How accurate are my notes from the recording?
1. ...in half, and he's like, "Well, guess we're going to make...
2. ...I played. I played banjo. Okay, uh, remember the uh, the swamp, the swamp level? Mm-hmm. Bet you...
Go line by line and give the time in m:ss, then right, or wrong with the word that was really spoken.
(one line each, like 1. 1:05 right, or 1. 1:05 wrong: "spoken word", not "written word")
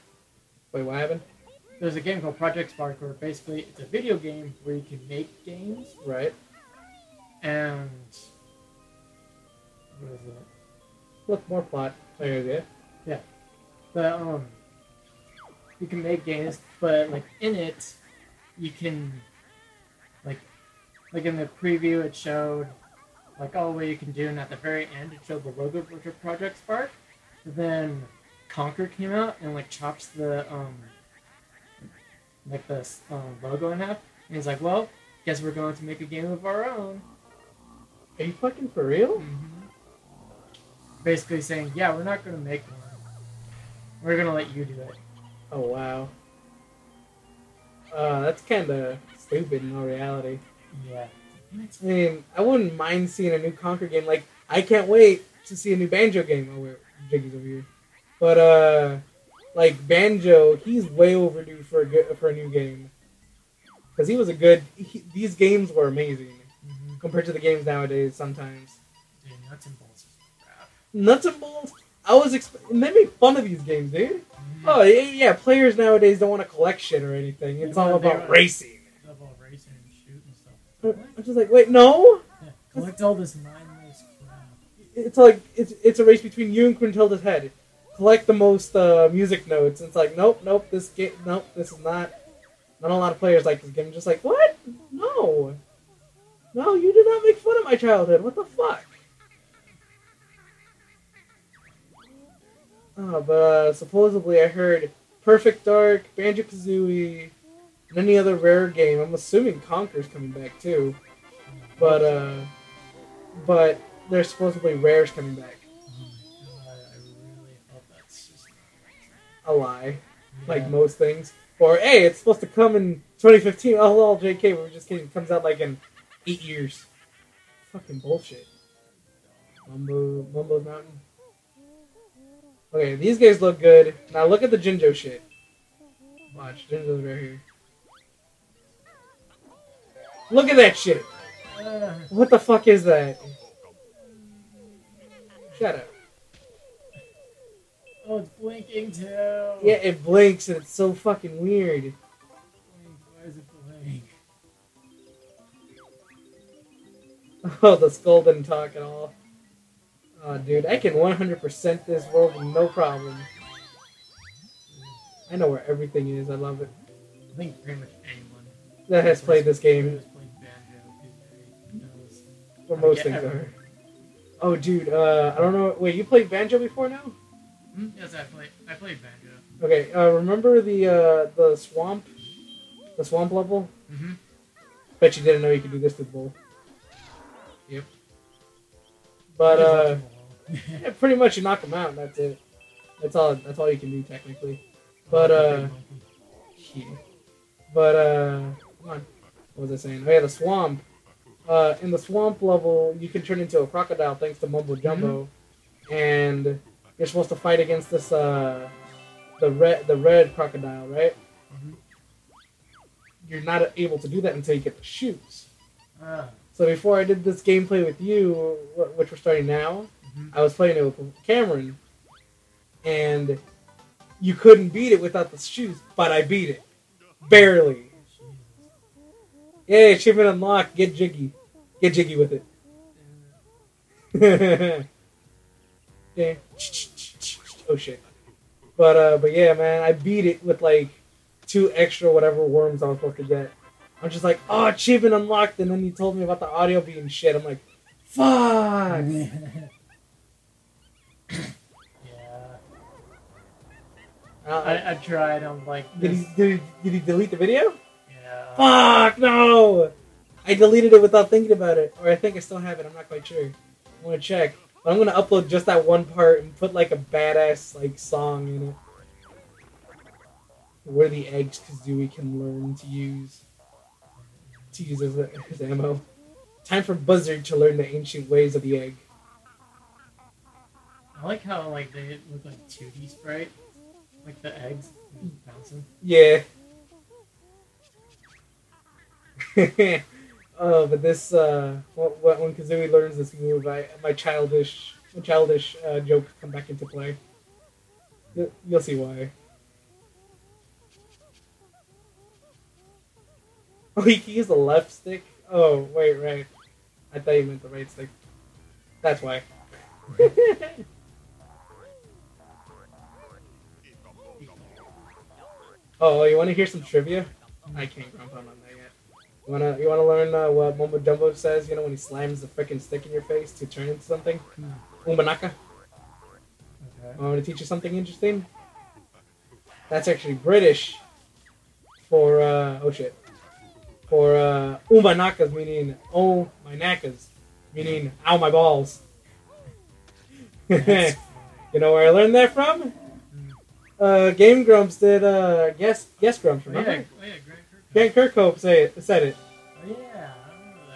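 1. 0:33 right
2. 2:58 right.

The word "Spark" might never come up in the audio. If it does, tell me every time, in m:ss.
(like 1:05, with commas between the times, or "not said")
0:02, 0:26.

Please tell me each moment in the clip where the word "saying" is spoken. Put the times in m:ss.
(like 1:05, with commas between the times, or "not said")
0:41, 3:19.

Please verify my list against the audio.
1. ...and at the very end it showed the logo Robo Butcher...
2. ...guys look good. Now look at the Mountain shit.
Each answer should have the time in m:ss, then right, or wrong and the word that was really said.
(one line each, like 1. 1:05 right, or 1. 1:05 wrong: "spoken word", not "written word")
1. 0:24 right
2. 2:13 wrong: "Jinjo", not "Mountain".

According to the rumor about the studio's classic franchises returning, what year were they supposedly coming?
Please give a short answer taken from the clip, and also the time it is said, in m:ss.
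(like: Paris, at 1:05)
2015, at 2:03.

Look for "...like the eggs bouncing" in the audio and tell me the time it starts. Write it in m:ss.
4:44.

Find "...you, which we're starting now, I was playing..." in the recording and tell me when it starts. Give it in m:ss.
3:37.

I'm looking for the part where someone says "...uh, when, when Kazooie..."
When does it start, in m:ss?
4:51.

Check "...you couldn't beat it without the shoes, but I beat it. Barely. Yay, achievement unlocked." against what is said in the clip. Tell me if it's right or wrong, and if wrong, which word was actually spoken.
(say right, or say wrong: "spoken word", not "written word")
right.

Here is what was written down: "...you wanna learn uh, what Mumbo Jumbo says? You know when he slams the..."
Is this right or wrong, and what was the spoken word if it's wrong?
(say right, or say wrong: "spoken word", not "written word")
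right.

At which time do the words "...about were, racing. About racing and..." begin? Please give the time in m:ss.
1:17.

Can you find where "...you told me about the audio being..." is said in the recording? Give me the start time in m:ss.
4:05.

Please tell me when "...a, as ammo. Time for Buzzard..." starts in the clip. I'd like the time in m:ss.
4:35.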